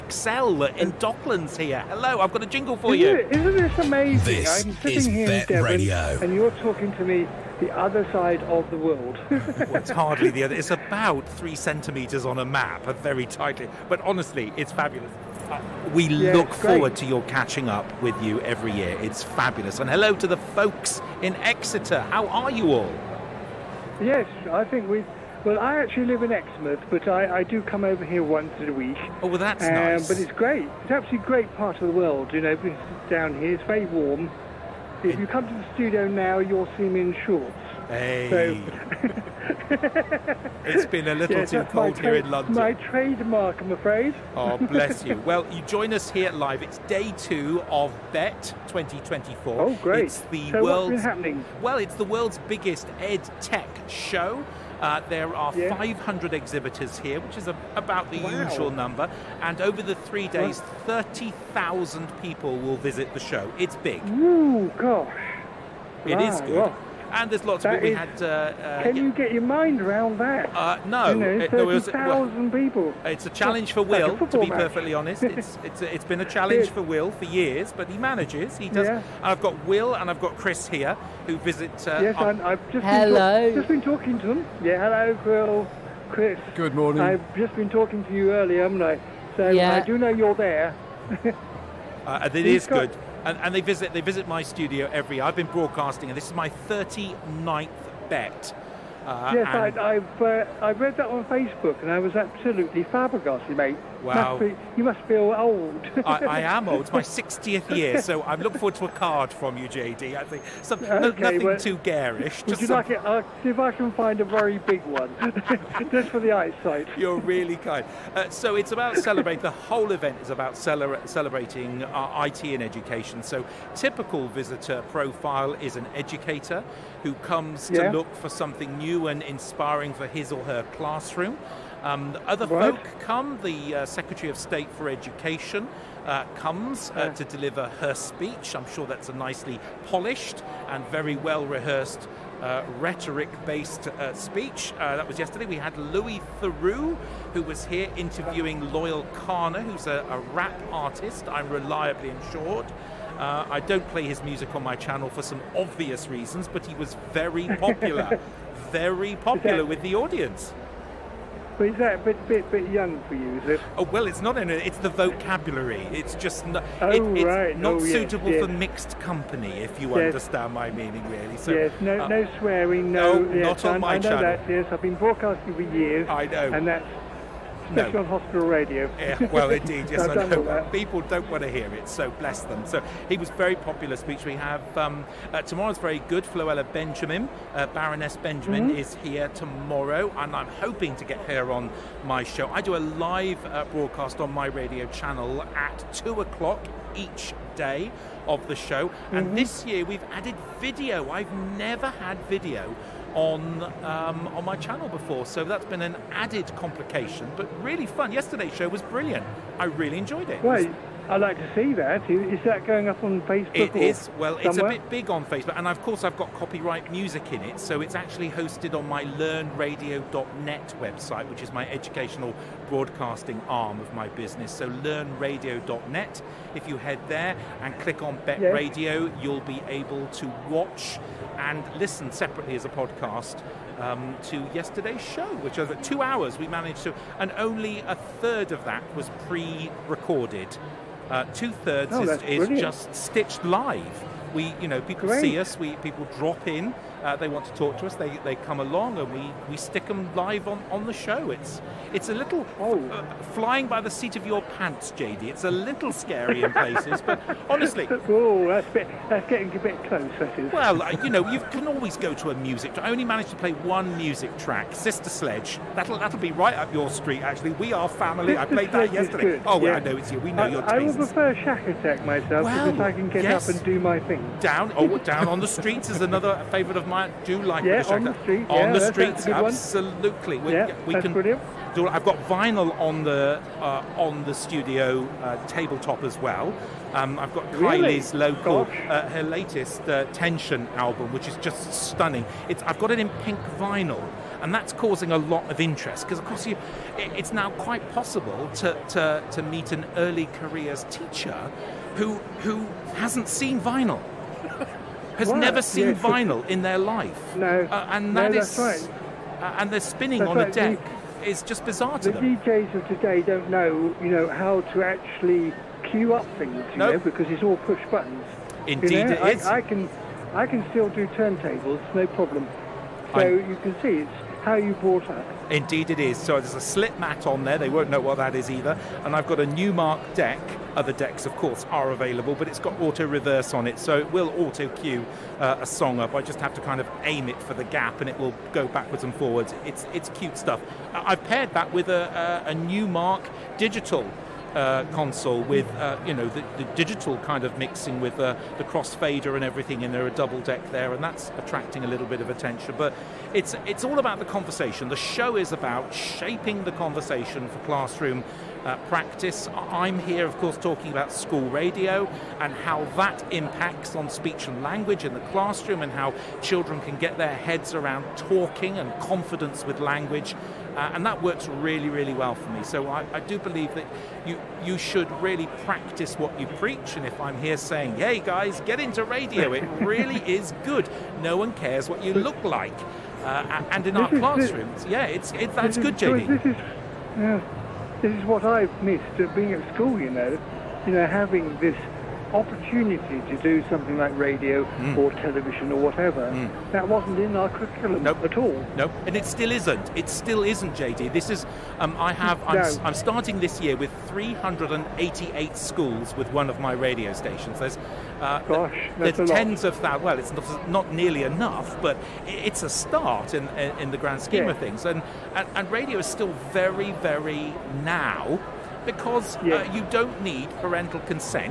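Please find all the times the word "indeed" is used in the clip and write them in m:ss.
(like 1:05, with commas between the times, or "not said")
2:59, 5:18, 5:25.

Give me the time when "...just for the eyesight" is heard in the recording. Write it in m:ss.
1:55.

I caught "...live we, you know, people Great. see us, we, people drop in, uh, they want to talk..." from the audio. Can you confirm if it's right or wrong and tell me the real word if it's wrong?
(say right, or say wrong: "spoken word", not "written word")
right.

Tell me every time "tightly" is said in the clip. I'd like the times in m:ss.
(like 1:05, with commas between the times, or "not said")
0:13.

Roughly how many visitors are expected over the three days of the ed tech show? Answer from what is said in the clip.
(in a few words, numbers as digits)
30,000.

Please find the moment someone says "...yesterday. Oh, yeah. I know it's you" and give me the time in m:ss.
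4:28.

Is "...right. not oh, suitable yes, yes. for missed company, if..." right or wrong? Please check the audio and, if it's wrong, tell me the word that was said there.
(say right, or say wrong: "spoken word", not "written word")
wrong: "mixed", not "missed".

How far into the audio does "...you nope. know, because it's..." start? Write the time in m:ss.
5:16.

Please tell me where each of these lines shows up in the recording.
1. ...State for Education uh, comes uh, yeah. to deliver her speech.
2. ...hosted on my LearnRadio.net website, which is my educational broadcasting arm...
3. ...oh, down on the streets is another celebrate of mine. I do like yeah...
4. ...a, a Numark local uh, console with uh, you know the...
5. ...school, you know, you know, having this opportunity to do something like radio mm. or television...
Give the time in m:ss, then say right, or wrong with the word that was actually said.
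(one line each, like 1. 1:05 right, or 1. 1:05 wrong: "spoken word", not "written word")
1. 2:14 right
2. 3:38 right
3. 4:34 wrong: "favourite", not "celebrate"
4. 5:42 wrong: "digital", not "local"
5. 6:29 right.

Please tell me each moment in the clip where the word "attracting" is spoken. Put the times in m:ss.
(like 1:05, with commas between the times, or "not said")
5:51.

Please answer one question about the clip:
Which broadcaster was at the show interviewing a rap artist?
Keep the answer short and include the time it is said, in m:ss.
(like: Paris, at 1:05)
Louis Theroux, at 2:25.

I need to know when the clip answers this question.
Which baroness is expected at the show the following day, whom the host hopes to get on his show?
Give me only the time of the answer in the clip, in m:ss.
3:06.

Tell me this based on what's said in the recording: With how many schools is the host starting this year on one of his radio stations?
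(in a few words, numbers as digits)
388.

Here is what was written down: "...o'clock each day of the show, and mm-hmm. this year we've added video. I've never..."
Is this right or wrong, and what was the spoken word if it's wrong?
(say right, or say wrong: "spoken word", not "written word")
right.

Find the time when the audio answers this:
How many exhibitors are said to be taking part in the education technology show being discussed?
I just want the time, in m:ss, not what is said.
0:55.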